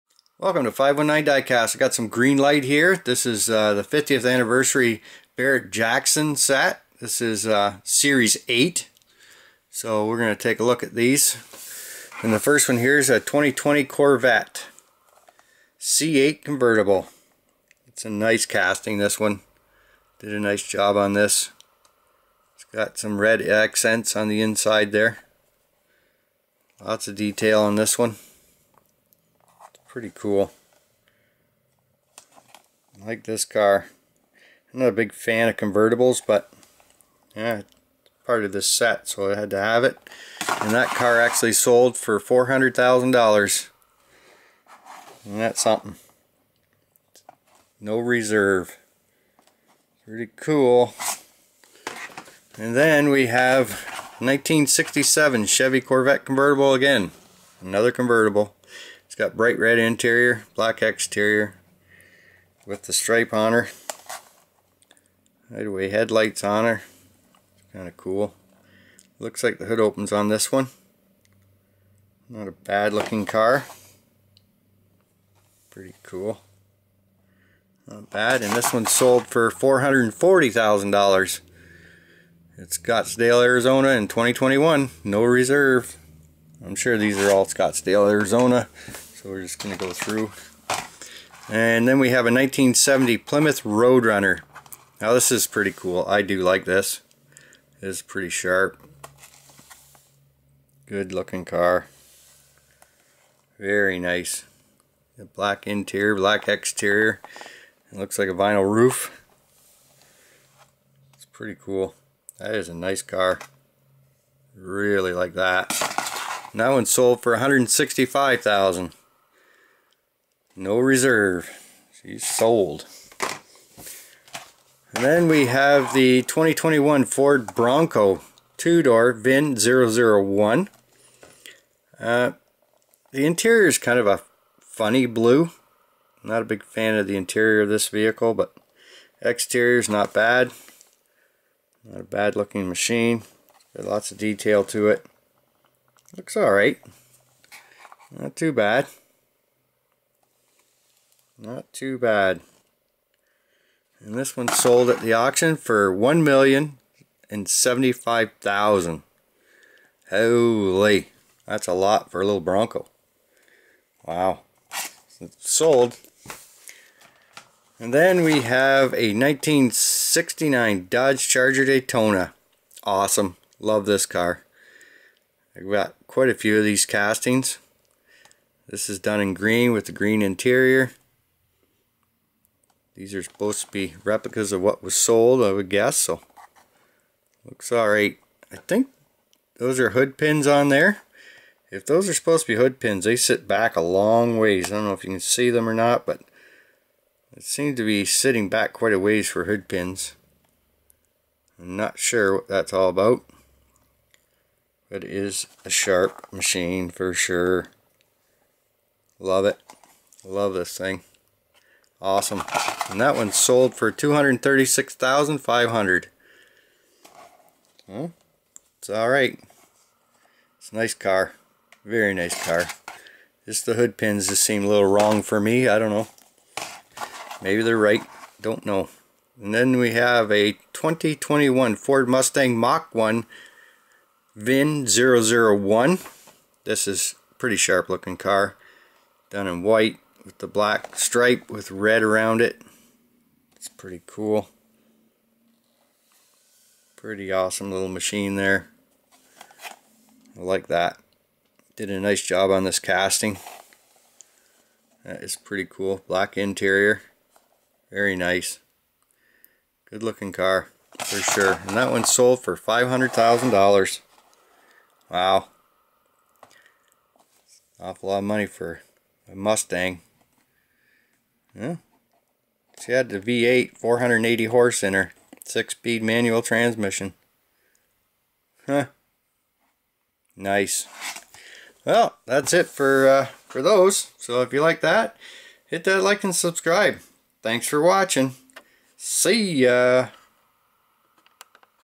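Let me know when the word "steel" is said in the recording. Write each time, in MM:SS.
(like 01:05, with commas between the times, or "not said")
not said.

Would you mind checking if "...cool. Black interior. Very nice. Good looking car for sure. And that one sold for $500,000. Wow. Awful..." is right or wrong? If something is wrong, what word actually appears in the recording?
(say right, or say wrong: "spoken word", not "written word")
right.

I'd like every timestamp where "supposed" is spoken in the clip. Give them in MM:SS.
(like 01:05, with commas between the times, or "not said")
03:03, 03:12.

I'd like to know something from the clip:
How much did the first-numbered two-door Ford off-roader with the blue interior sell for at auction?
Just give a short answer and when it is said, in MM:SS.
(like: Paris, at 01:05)
$1,075,000, at 02:35.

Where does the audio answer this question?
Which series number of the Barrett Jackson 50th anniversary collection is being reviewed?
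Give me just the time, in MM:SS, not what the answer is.
00:07.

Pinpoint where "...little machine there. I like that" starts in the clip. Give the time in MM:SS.
04:07.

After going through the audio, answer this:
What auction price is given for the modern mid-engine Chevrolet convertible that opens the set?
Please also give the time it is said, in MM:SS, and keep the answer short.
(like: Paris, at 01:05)
$400,000, at 00:42.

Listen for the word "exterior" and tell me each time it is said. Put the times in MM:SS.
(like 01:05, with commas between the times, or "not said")
01:00, 01:46, 02:19.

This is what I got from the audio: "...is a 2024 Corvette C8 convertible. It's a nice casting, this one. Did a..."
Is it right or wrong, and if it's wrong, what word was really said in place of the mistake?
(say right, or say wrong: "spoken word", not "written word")
wrong: "2020", not "2024".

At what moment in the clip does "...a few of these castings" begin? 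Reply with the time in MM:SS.
02:56.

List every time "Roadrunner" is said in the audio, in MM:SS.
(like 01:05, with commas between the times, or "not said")
01:33.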